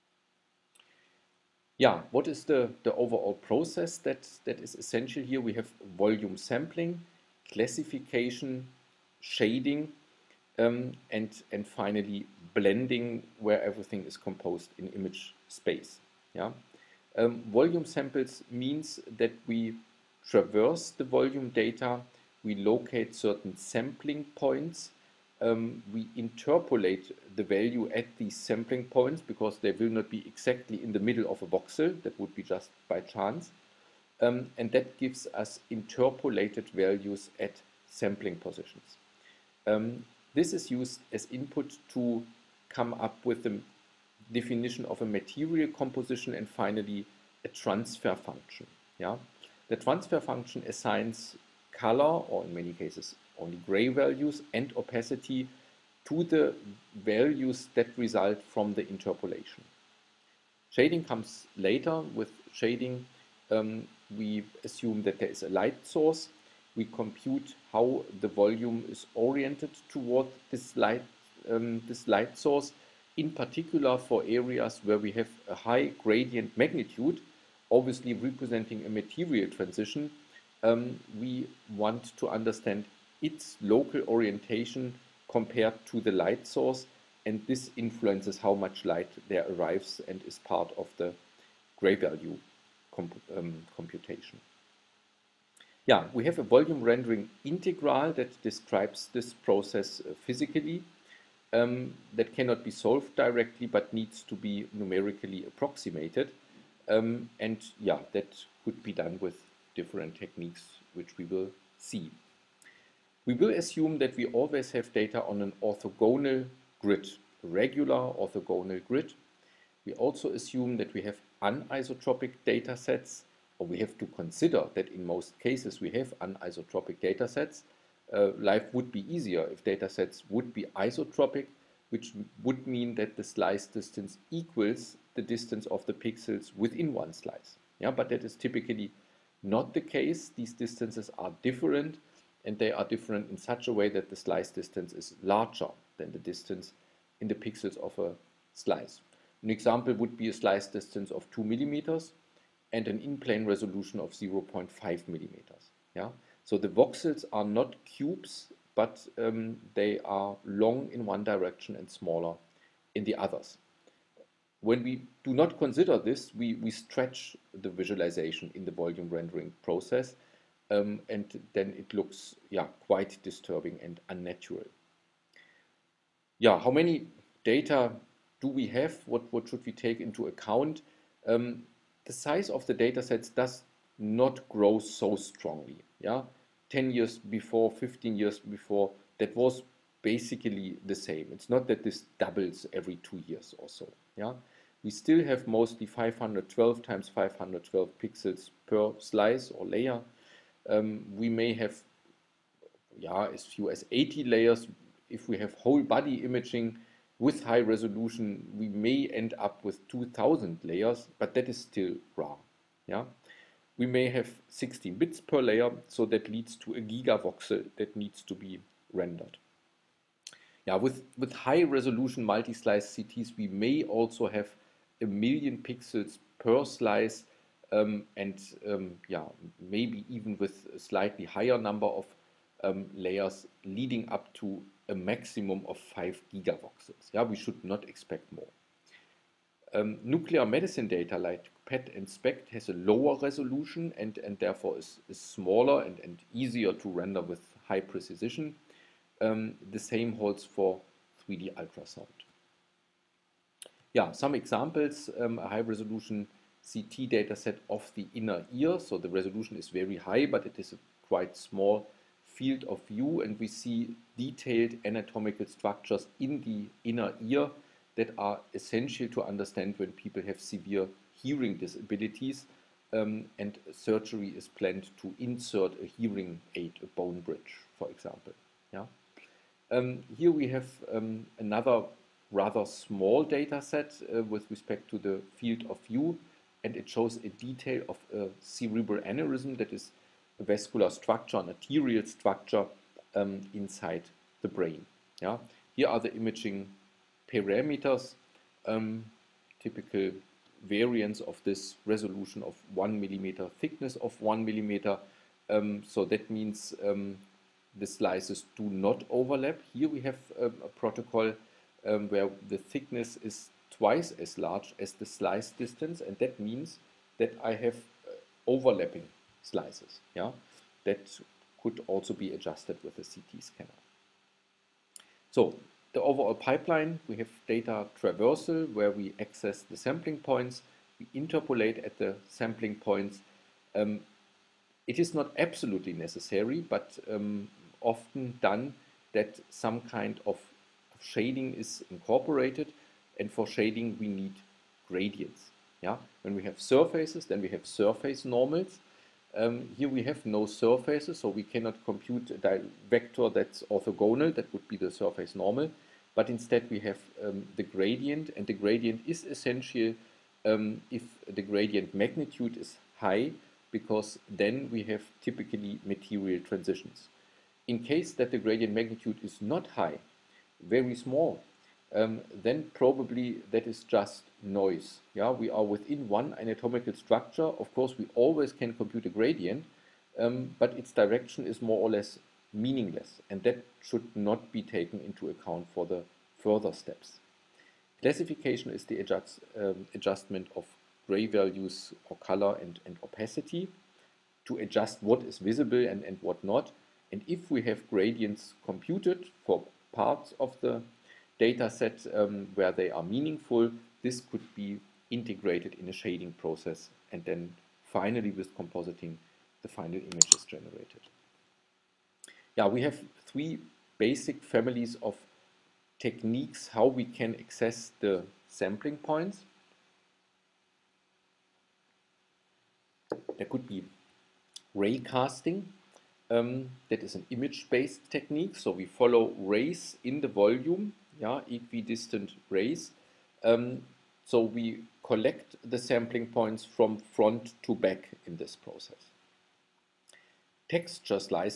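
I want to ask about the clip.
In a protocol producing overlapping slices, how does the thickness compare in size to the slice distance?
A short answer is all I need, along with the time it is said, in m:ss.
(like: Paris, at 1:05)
twice as large, at 5:13.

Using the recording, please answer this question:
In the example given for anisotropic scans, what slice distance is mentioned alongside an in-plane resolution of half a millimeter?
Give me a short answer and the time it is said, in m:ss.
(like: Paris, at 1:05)
2 millimeters, at 2:31.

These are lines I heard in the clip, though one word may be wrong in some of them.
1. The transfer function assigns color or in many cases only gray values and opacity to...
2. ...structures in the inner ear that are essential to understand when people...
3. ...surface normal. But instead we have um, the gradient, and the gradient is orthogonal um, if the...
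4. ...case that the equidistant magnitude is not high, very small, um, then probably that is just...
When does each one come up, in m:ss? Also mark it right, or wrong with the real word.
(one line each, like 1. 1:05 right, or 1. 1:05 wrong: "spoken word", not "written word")
1. 0:49 right
2. 4:25 right
3. 5:54 wrong: "essential", not "orthogonal"
4. 6:07 wrong: "gradient", not "equidistant".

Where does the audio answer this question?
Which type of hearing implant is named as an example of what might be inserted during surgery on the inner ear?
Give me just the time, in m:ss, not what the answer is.
4:36.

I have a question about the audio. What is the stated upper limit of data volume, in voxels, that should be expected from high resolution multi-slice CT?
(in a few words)
5 gigavoxels.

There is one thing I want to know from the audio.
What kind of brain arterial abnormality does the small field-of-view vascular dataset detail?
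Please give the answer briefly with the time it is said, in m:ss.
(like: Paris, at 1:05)
cerebral aneurysm, at 4:48.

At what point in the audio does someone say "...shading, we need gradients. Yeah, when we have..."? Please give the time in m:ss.
5:43.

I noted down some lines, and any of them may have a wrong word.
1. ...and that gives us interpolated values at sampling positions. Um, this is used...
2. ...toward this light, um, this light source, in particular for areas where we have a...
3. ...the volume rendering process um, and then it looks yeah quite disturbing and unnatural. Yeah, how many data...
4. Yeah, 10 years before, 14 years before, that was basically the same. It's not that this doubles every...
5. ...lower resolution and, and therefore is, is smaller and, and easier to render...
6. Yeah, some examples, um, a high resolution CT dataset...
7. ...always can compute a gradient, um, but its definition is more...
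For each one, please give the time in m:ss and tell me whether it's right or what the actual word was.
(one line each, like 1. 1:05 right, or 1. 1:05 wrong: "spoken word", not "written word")
1. 0:34 right
2. 1:09 right
3. 2:48 right
4. 3:06 wrong: "15", not "14"
5. 4:02 right
6. 4:13 right
7. 6:18 wrong: "direction", not "definition".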